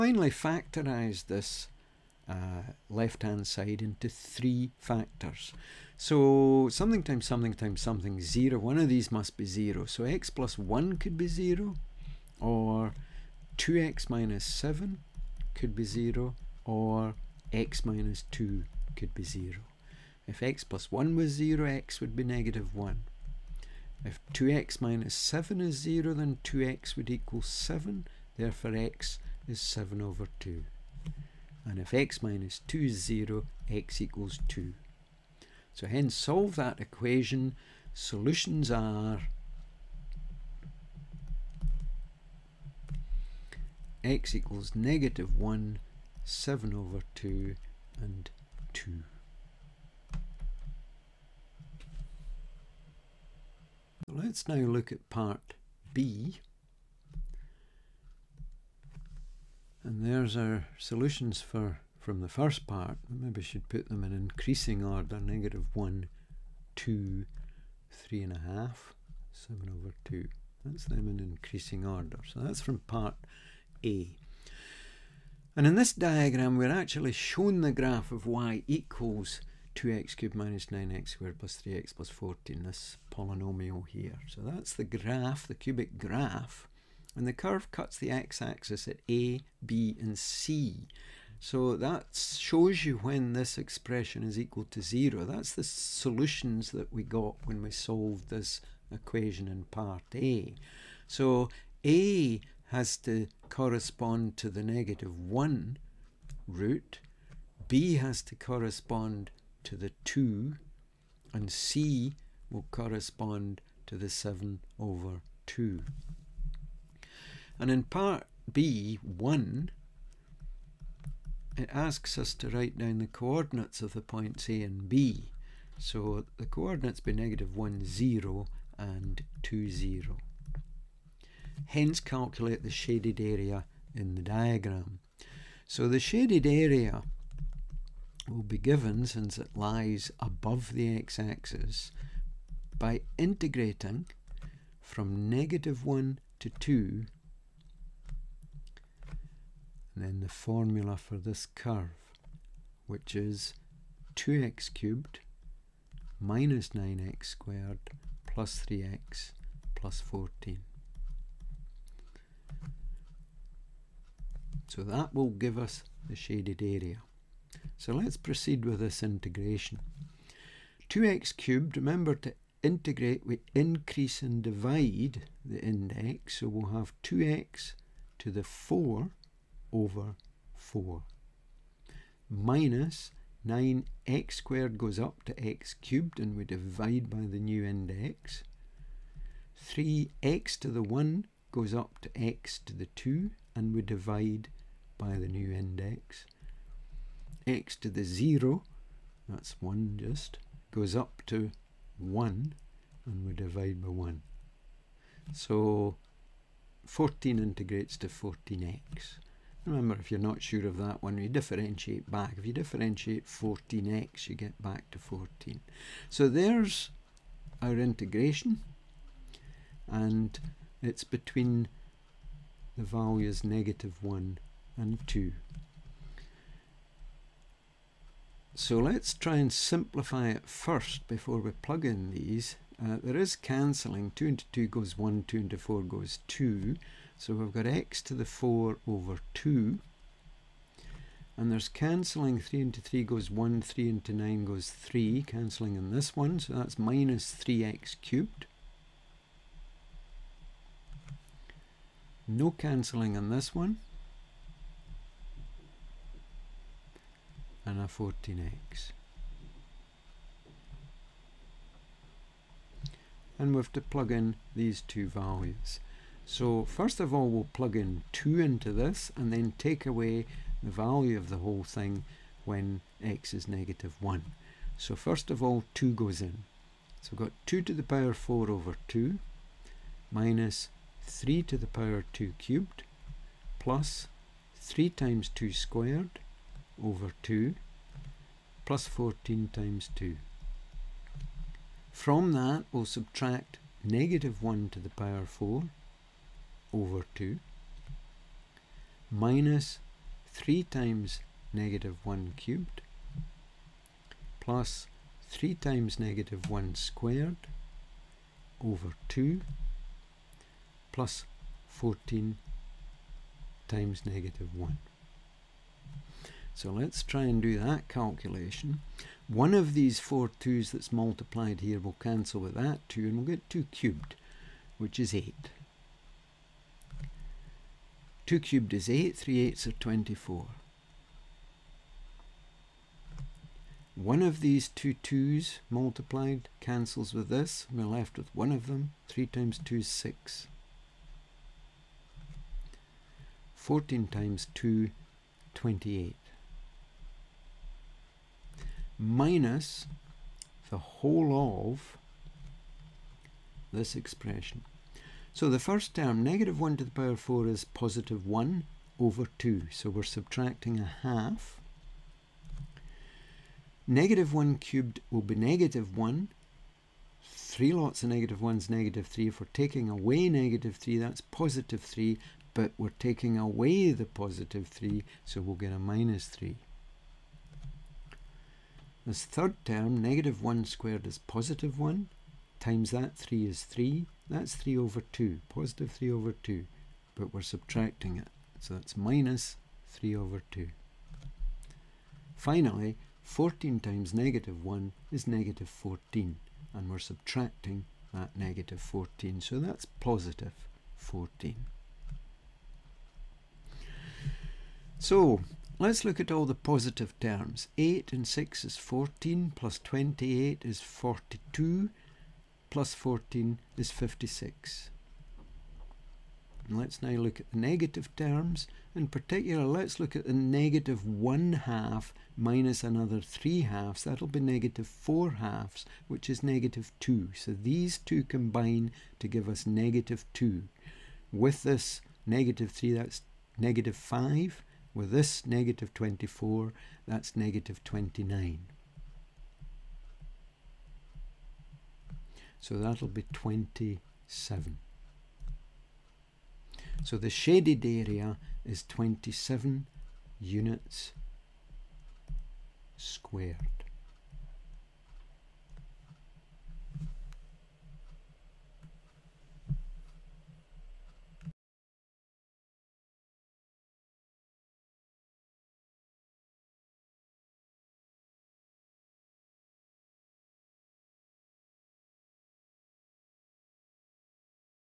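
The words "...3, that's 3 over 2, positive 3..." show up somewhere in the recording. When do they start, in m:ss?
6:23.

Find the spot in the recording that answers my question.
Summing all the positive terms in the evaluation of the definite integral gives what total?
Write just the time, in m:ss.
6:53.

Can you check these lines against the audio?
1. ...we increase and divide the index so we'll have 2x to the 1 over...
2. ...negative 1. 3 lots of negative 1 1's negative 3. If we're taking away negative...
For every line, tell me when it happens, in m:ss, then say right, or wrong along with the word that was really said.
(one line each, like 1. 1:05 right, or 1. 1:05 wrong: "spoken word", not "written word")
1. 2:53 wrong: "4", not "1"
2. 6:05 right.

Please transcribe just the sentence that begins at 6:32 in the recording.
Finally, 14 times negative 1 is negative 14, and we're subtracting that negative 14, so that's positive 14.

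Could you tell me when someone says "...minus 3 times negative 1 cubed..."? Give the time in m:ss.
4:59.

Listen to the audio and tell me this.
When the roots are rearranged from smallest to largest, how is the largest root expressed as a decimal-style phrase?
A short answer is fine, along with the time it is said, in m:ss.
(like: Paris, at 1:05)
3 and a half, at 1:07.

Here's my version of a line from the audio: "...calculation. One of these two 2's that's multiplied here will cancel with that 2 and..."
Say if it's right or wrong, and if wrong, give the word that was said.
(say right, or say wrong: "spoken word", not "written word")
wrong: "four", not "two".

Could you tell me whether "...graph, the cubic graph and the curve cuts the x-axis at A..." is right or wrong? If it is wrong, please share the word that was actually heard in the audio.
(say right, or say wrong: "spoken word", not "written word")
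right.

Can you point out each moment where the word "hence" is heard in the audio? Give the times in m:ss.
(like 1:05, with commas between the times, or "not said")
0:35, 2:11.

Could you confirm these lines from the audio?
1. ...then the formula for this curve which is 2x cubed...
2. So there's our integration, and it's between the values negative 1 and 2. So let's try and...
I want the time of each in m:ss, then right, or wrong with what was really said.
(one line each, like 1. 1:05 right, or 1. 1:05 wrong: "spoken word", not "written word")
1. 2:30 right
2. 3:36 right.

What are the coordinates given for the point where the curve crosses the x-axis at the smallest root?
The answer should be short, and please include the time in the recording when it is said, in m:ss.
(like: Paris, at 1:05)
(-1, 0), at 2:07.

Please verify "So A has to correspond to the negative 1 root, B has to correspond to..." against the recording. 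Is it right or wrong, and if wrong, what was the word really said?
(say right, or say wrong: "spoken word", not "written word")
right.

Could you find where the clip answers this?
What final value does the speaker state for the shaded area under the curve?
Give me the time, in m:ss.
7:28.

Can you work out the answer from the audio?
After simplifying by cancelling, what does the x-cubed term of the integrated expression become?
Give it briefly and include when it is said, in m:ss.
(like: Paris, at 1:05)
-3x cubed, at 4:06.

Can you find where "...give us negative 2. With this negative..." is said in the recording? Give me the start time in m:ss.
7:09.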